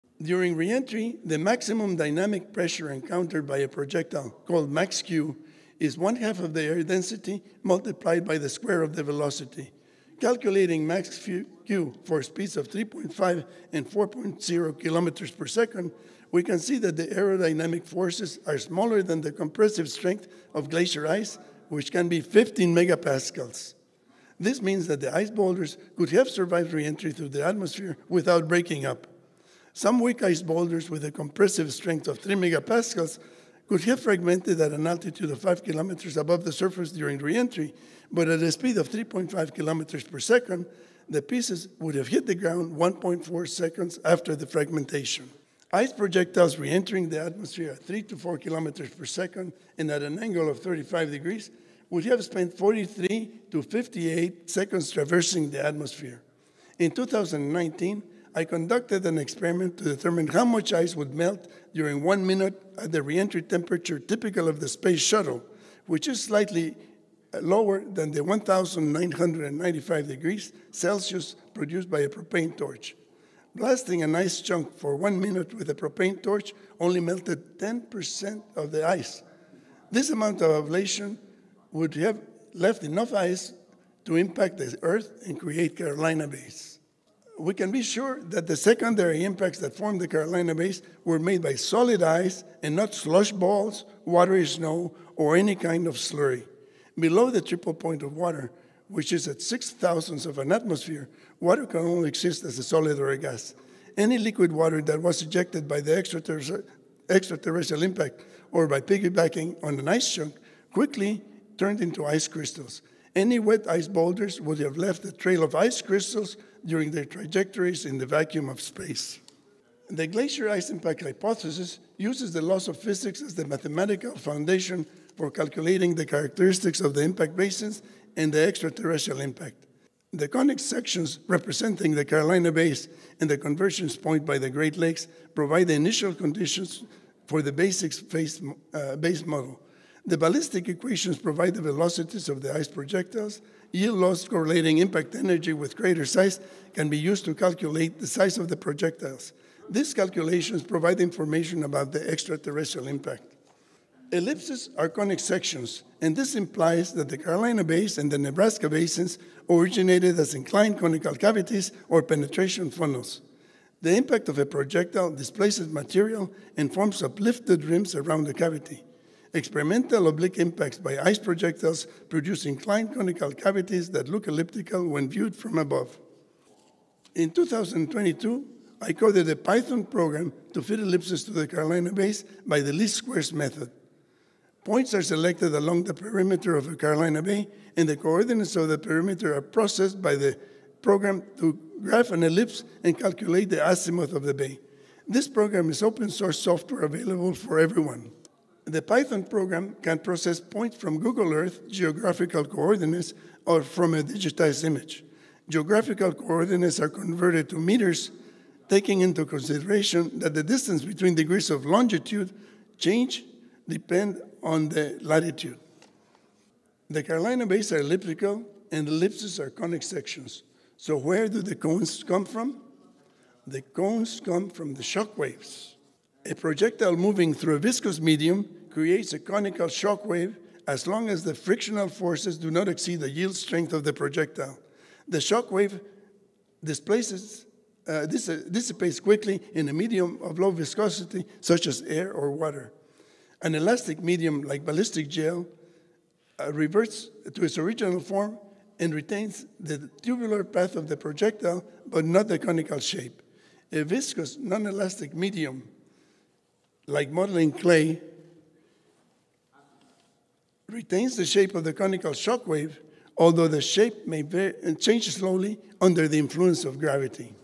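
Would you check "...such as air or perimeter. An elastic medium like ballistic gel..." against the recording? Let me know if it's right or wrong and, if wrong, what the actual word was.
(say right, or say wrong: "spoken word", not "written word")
wrong: "water", not "perimeter".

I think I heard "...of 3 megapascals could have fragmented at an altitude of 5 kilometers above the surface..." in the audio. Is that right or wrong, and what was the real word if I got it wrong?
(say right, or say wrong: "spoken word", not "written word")
right.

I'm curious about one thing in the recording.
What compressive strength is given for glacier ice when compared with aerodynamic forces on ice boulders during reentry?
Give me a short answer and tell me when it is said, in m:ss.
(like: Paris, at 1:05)
15 megapascals, at 0:22.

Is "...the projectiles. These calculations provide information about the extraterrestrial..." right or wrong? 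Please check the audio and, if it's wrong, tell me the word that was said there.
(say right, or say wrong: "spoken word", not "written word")
right.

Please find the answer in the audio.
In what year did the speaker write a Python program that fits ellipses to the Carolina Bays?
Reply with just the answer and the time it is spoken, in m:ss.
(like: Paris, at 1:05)
2022, at 2:57.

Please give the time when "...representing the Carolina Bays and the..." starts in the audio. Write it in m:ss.
2:11.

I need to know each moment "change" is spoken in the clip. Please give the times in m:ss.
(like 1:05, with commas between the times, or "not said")
3:32, 4:24.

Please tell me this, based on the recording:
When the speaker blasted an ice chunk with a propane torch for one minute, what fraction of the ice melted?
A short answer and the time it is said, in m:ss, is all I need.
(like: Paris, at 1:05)
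10%, at 1:17.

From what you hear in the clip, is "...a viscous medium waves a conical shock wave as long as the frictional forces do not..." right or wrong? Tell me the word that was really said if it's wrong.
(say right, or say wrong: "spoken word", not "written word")
wrong: "creates", not "waves".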